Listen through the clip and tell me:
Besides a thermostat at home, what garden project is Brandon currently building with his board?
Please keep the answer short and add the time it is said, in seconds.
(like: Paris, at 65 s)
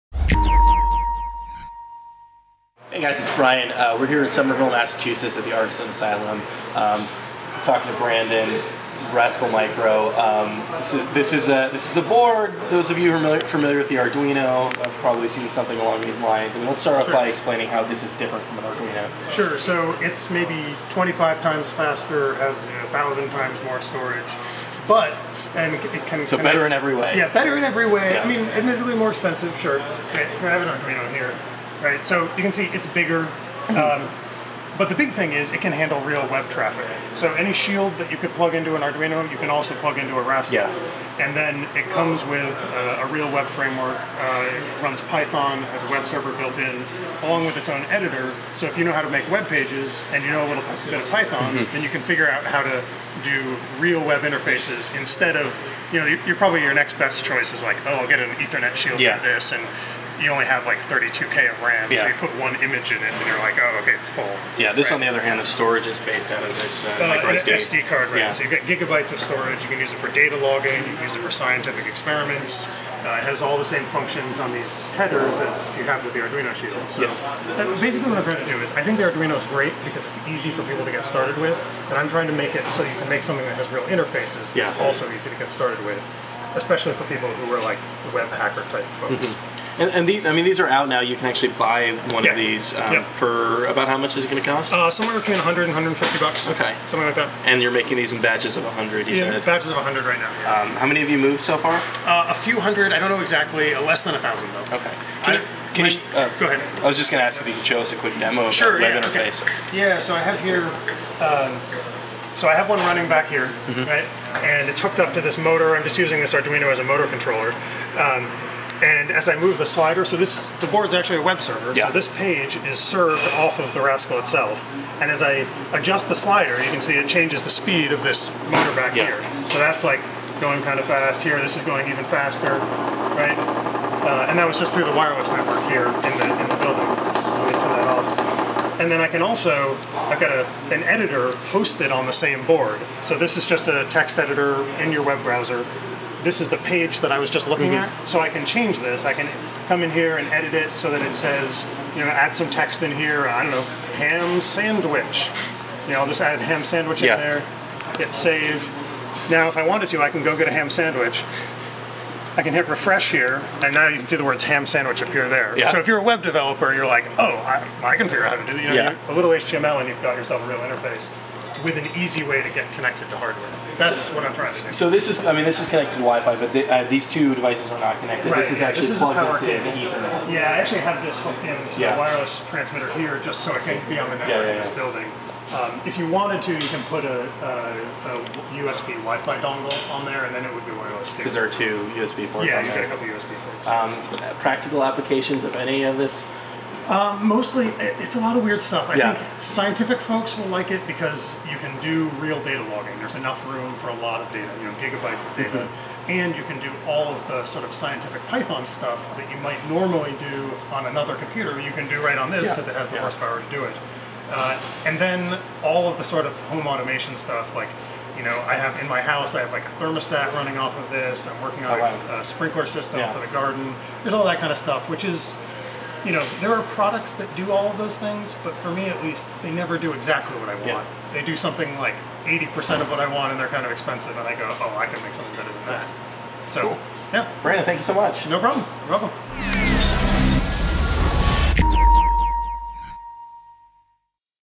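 a sprinkler system, at 222 s.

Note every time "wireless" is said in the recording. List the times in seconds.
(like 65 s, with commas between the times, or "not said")
134 s, 181 s, 190 s.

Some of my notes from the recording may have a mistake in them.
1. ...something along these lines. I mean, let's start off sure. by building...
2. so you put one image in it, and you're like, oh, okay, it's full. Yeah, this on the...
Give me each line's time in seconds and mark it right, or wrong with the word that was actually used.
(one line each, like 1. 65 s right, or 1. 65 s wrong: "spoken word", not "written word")
1. 15 s wrong: "explaining", not "building"
2. 61 s right.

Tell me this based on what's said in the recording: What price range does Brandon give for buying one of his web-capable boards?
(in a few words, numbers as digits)
$100 to $150.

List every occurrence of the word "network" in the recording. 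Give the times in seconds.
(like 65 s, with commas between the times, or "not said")
135 s, 184 s.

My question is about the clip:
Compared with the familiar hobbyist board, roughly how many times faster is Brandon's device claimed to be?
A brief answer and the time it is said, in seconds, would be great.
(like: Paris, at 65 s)
25 times, at 20 s.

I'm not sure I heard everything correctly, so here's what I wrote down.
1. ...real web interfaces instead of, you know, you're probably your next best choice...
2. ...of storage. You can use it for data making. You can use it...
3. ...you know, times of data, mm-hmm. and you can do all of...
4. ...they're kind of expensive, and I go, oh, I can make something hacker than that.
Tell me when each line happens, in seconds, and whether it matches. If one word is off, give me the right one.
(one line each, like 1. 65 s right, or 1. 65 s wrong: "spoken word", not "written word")
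1. 53 s right
2. 69 s wrong: "logging", not "making"
3. 204 s wrong: "gigabytes", not "times"
4. 233 s wrong: "better", not "hacker".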